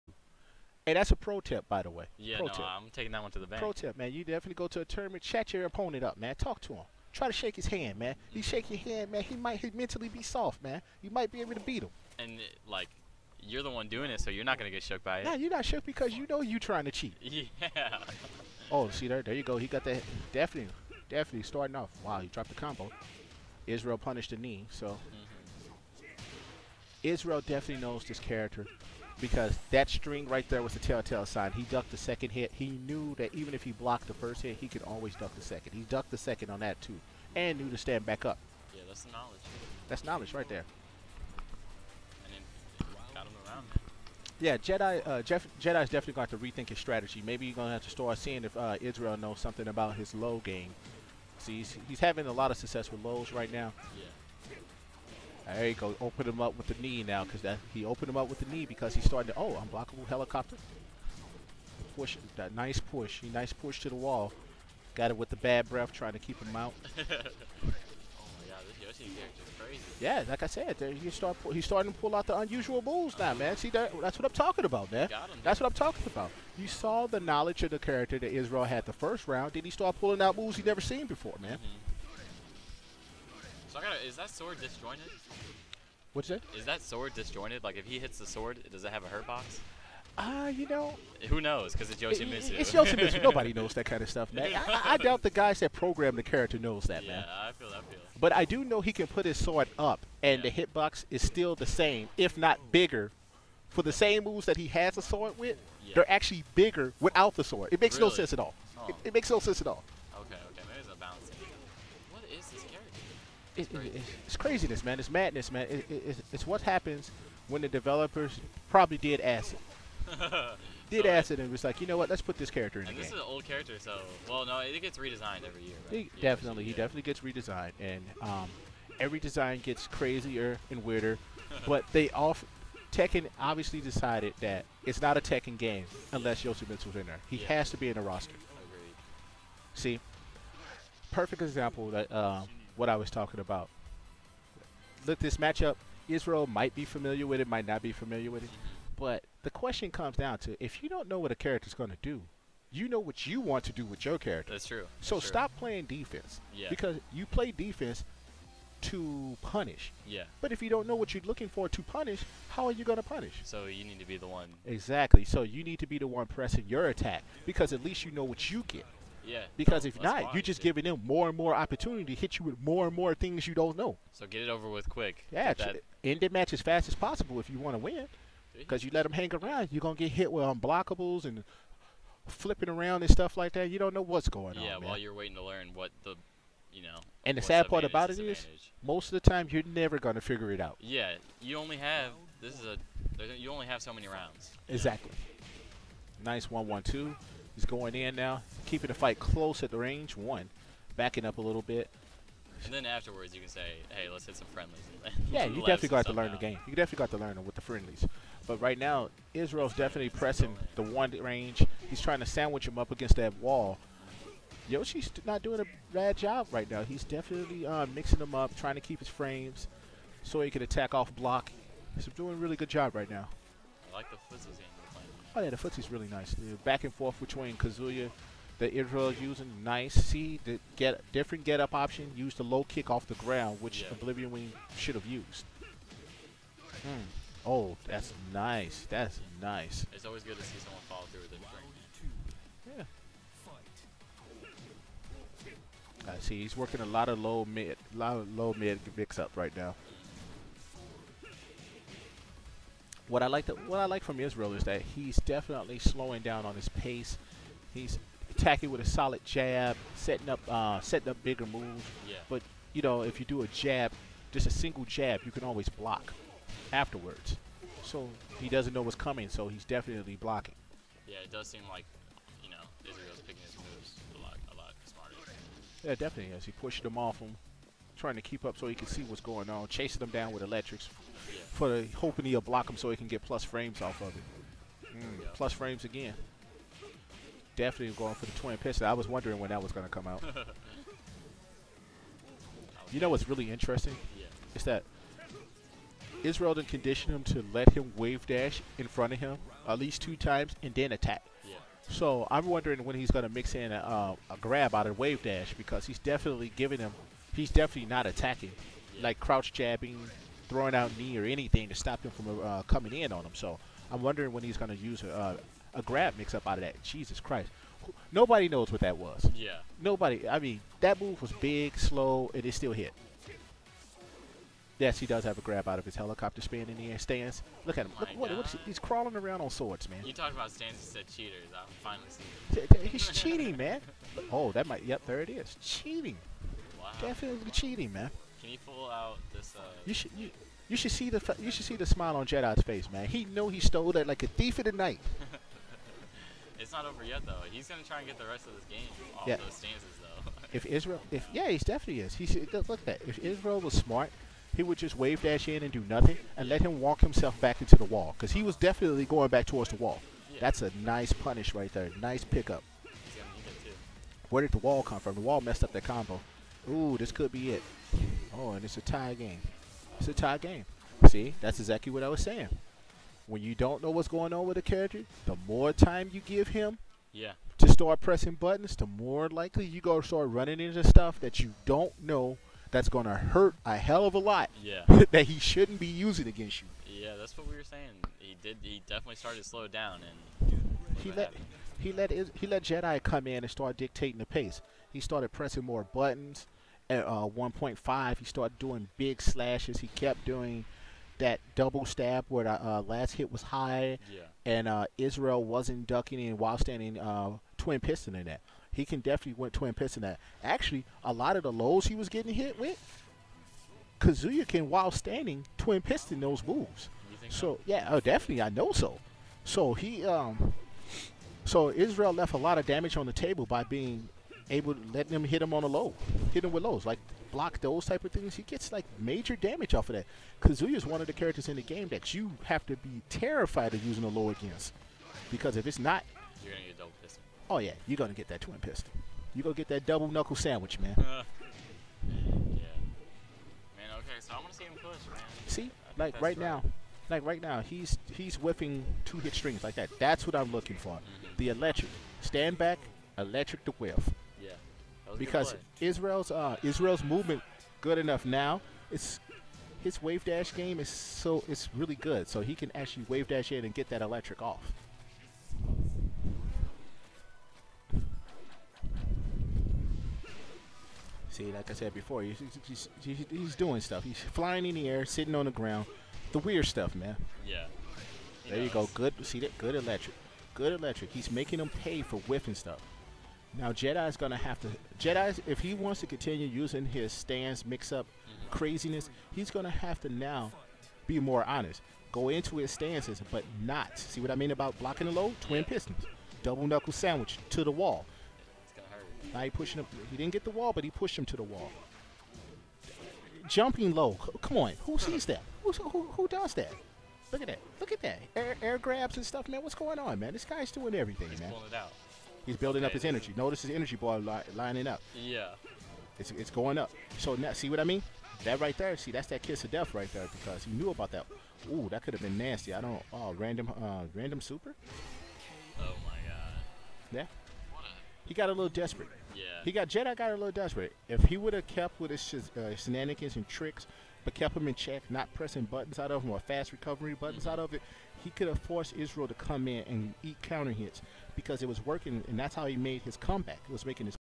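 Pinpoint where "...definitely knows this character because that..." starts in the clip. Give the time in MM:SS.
00:27.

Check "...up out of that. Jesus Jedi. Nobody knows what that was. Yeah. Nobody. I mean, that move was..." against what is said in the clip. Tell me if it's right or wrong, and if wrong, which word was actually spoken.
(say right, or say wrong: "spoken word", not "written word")
wrong: "Christ", not "Jedi".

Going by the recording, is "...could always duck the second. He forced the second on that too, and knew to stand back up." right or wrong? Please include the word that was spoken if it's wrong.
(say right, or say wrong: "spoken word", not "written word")
wrong: "ducked", not "forced".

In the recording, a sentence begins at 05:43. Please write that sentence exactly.
He know he stole that like a thief of the night.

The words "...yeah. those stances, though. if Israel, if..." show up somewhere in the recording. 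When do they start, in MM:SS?
05:49.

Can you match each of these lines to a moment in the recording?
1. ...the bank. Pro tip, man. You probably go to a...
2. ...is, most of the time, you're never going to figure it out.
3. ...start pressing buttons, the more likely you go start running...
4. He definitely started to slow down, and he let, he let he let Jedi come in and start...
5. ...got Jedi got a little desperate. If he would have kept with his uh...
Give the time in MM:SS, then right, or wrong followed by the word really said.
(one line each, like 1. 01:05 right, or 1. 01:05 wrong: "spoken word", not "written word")
1. 00:03 wrong: "definitely", not "probably"
2. 03:08 right
3. 06:17 right
4. 06:28 right
5. 08:49 right.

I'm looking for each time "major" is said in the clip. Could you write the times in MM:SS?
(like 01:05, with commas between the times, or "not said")
07:08.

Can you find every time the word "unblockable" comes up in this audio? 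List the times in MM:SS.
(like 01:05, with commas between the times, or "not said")
00:59, 03:00.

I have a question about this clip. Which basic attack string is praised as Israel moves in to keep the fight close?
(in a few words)
1 1 2.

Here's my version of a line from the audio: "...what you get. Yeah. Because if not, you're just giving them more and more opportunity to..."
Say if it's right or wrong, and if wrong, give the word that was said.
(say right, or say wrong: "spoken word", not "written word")
right.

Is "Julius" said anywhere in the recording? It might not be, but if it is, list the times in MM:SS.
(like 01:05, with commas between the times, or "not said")
not said.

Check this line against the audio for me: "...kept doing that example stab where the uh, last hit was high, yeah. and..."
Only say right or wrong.
wrong.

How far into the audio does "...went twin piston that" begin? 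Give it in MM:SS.
06:49.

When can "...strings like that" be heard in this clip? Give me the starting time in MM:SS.
07:29.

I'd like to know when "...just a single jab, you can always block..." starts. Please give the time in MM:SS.
04:24.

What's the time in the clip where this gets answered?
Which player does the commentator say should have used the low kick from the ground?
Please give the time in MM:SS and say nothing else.
03:53.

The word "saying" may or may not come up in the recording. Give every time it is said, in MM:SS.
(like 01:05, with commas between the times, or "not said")
06:12, 06:27.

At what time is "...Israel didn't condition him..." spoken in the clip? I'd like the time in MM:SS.
04:56.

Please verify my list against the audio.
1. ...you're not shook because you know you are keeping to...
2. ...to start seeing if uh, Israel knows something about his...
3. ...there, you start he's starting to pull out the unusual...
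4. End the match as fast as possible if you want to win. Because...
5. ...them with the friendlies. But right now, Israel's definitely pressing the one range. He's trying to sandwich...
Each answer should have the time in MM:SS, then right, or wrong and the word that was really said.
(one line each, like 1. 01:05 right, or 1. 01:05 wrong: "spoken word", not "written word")
1. 00:15 wrong: "trying", not "keeping"
2. 00:47 right
3. 01:10 right
4. 02:56 right
5. 03:27 right.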